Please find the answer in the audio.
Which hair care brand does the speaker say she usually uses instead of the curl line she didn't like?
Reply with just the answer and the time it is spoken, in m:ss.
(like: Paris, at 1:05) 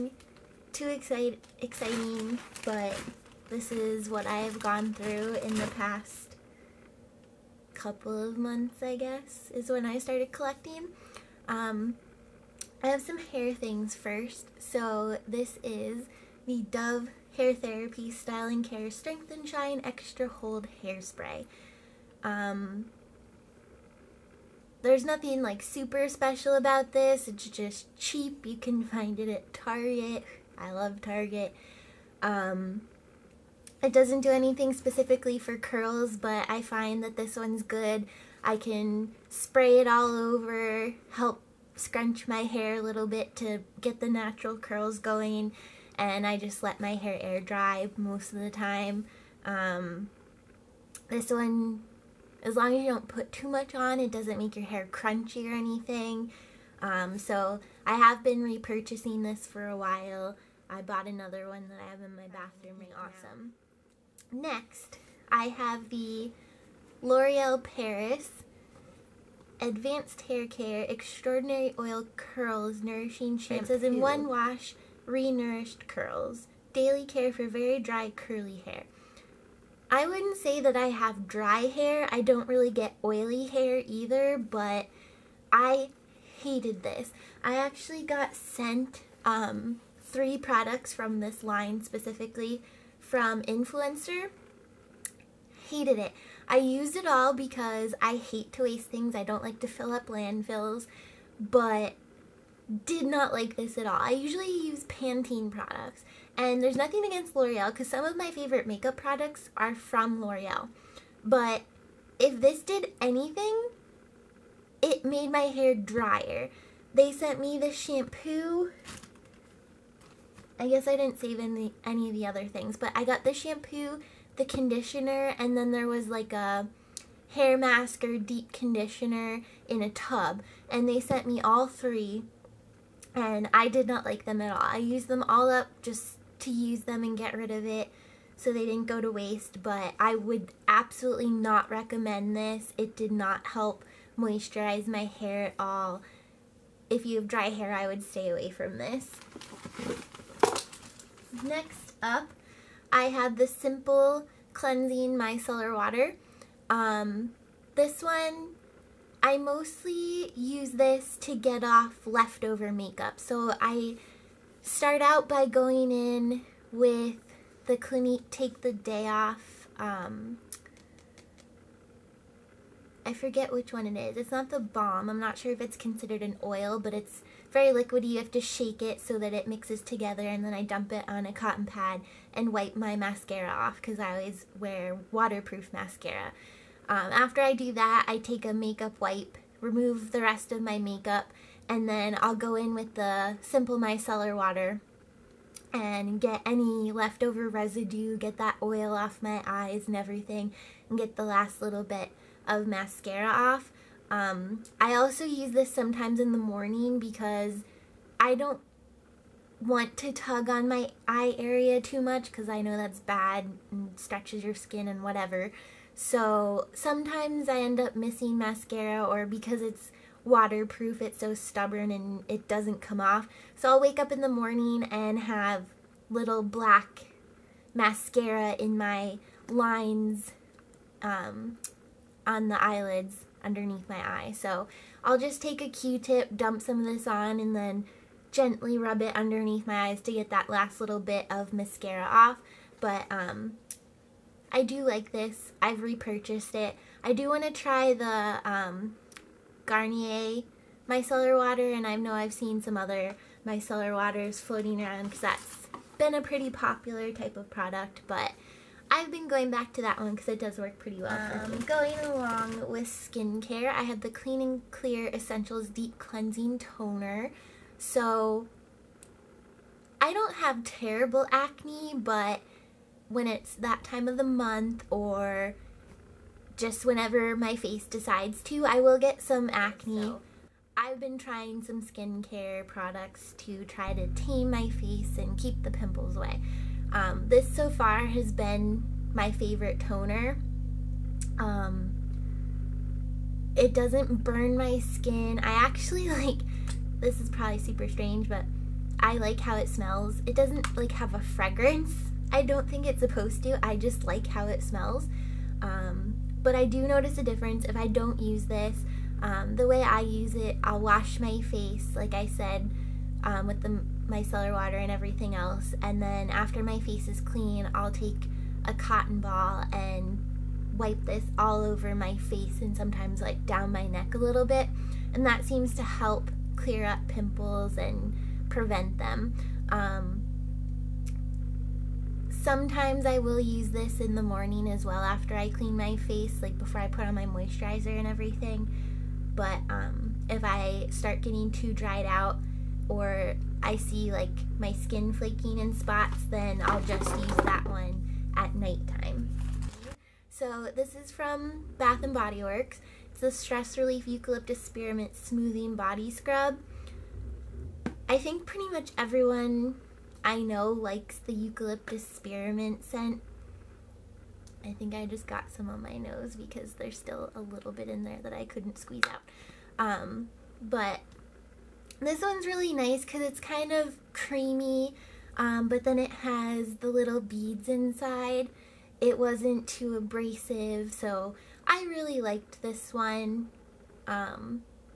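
Pantene, at 1:44.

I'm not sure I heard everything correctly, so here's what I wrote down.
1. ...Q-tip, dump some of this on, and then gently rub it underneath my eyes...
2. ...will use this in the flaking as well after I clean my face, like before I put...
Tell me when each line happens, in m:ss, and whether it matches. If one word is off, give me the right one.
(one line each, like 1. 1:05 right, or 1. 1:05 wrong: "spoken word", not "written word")
1. 3:55 right
2. 5:33 wrong: "morning", not "flaking".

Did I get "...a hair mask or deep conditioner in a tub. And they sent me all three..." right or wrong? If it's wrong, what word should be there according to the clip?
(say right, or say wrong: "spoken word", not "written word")
right.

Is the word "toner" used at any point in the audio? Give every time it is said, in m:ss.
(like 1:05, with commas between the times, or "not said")
4:26, 4:49.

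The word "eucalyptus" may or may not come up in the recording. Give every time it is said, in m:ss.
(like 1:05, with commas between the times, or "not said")
5:54, 6:01.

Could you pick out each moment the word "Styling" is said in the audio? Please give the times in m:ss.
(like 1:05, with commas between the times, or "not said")
0:18.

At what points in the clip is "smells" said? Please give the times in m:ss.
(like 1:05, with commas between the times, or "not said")
4:59, 5:04.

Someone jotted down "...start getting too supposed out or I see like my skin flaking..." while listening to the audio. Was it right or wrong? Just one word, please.
wrong.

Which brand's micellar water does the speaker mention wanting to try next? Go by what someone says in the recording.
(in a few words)
Garnier.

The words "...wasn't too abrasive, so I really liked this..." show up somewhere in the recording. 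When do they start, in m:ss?
6:19.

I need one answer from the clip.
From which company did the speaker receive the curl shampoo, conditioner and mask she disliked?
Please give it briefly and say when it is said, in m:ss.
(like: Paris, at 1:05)
Influenster, at 1:33.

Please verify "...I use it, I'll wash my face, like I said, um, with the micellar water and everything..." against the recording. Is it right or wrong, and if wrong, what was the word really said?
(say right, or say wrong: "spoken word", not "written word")
right.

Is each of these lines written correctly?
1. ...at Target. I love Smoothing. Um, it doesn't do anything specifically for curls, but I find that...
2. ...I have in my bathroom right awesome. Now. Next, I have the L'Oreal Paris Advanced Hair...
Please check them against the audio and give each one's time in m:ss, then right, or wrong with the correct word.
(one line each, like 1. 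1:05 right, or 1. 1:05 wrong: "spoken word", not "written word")
1. 0:29 wrong: "Target", not "Smoothing"
2. 1:01 right.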